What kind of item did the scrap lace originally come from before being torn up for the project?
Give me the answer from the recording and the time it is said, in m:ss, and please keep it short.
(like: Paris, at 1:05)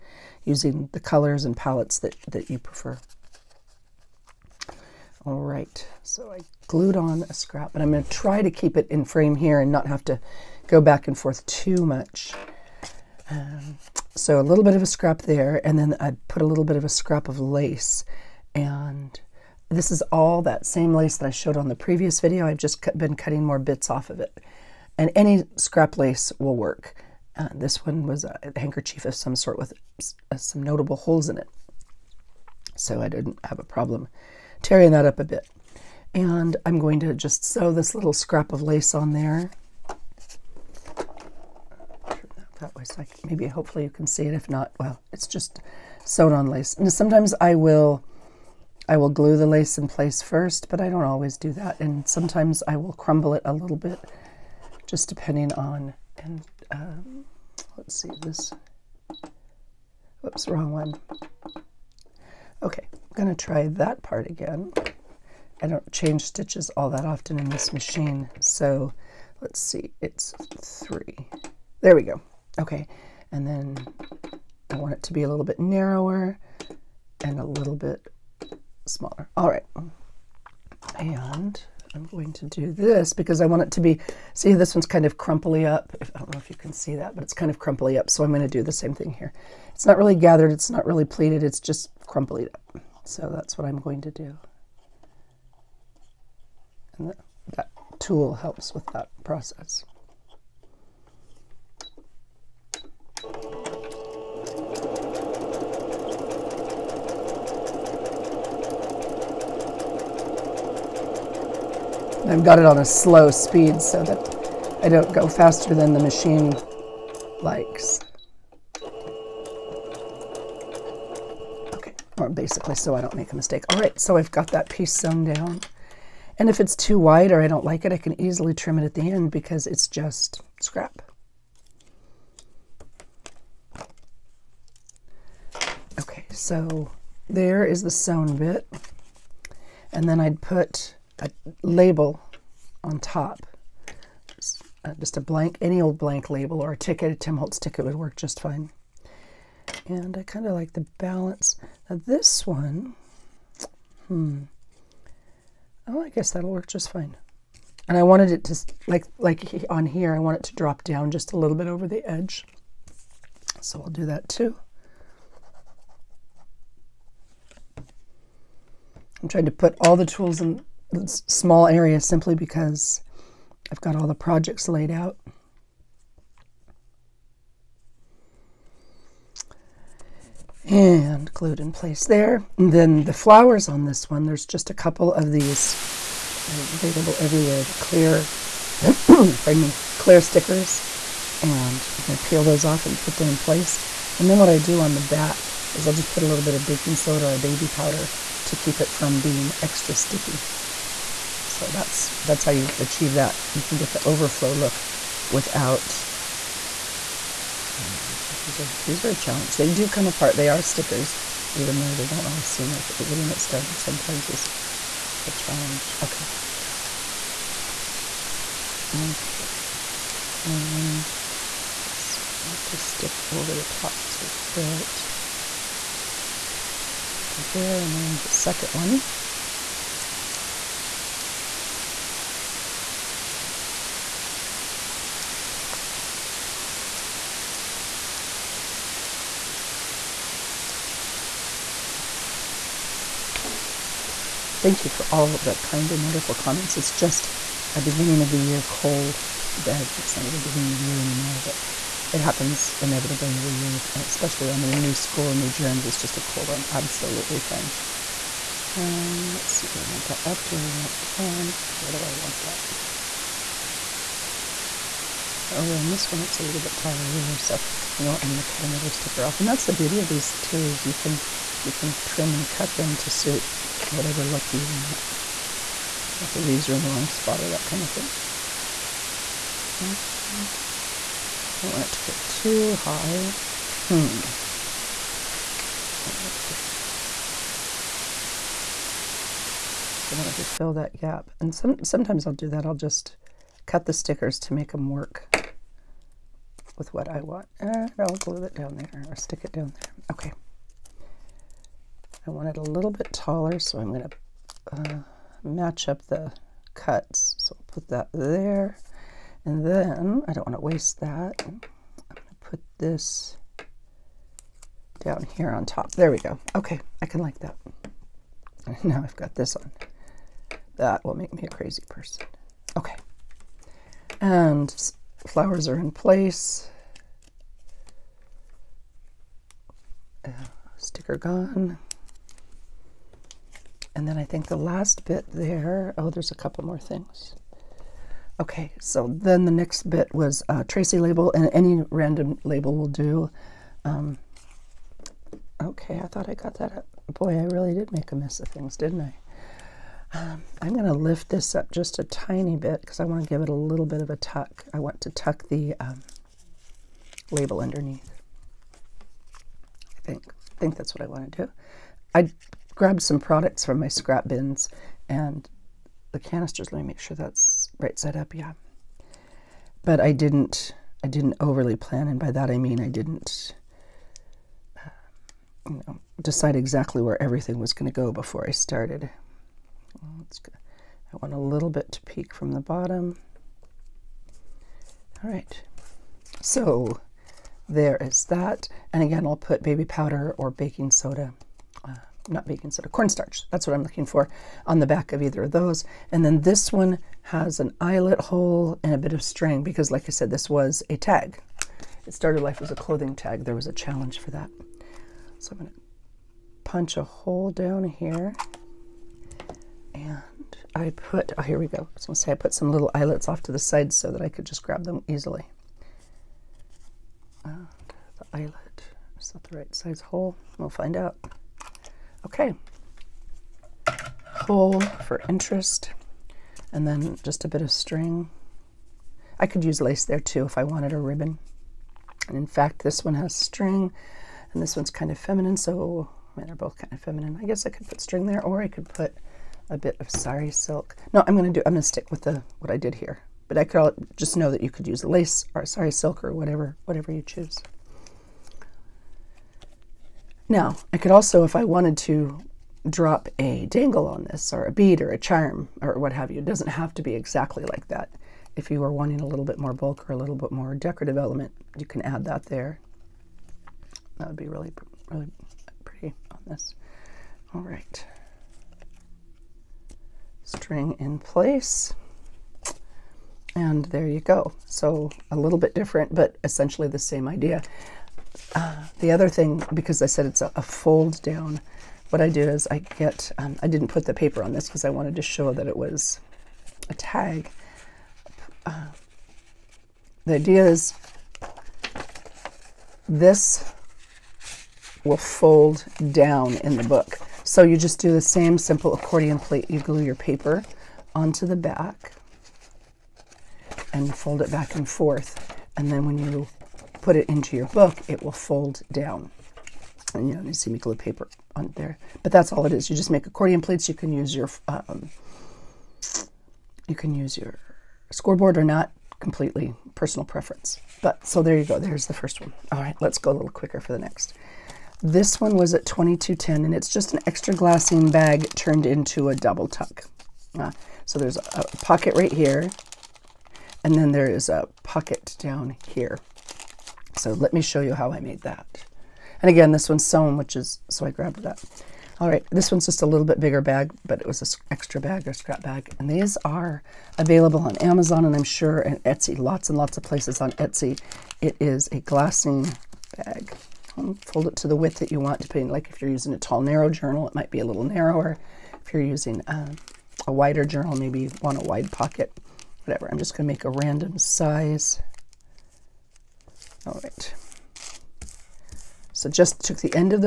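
handkerchief, at 0:28.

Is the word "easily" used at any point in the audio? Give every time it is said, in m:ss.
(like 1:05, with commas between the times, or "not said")
2:08, 6:55.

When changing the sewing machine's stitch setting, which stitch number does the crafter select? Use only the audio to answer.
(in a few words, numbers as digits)
3.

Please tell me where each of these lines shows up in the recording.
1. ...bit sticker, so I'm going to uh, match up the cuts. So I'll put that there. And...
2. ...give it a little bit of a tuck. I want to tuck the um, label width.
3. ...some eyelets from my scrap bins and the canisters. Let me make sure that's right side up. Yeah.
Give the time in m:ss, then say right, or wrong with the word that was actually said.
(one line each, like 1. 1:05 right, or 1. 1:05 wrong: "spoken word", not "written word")
1. 5:02 wrong: "taller", not "sticker"
2. 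5:53 wrong: "underneath", not "width"
3. 6:03 wrong: "products", not "eyelets".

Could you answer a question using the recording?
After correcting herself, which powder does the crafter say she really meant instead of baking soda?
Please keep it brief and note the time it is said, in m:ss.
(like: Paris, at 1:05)
cornstarch, at 6:32.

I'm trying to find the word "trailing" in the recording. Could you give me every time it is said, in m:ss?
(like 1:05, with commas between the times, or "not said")
not said.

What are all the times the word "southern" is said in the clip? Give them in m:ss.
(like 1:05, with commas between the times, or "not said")
not said.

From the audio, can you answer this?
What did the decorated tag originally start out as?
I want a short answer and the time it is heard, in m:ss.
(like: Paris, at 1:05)
clothing tag, at 6:42.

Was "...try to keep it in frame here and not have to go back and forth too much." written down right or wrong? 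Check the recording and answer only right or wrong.
right.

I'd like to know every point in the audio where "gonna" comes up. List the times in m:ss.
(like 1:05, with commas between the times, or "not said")
1:03, 6:45, 6:52, 9:23.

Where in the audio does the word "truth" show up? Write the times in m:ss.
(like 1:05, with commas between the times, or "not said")
not said.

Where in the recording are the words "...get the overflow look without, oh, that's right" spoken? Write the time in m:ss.
3:23.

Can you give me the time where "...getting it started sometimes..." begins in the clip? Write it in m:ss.
3:33.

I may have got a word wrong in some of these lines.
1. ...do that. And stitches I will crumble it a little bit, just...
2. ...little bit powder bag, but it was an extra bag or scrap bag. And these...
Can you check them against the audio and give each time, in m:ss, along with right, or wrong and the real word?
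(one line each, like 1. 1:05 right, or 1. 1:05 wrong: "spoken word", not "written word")
1. 0:51 wrong: "sometimes", not "stitches"
2. 9:03 wrong: "bigger", not "powder".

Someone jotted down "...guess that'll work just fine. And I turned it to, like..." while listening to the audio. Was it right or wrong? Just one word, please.
wrong.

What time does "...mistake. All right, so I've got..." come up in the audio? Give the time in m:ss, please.
2:03.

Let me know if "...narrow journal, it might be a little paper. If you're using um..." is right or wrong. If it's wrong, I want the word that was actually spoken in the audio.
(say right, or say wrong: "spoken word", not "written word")
wrong: "narrower", not "paper".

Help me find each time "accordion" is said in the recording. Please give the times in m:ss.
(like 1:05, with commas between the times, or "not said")
8:18, 8:33.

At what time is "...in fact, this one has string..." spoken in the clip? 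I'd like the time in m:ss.
7:12.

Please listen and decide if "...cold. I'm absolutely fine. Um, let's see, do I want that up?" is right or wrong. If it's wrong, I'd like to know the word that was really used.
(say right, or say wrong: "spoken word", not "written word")
right.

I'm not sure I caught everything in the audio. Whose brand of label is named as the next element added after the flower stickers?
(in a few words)
Tracy.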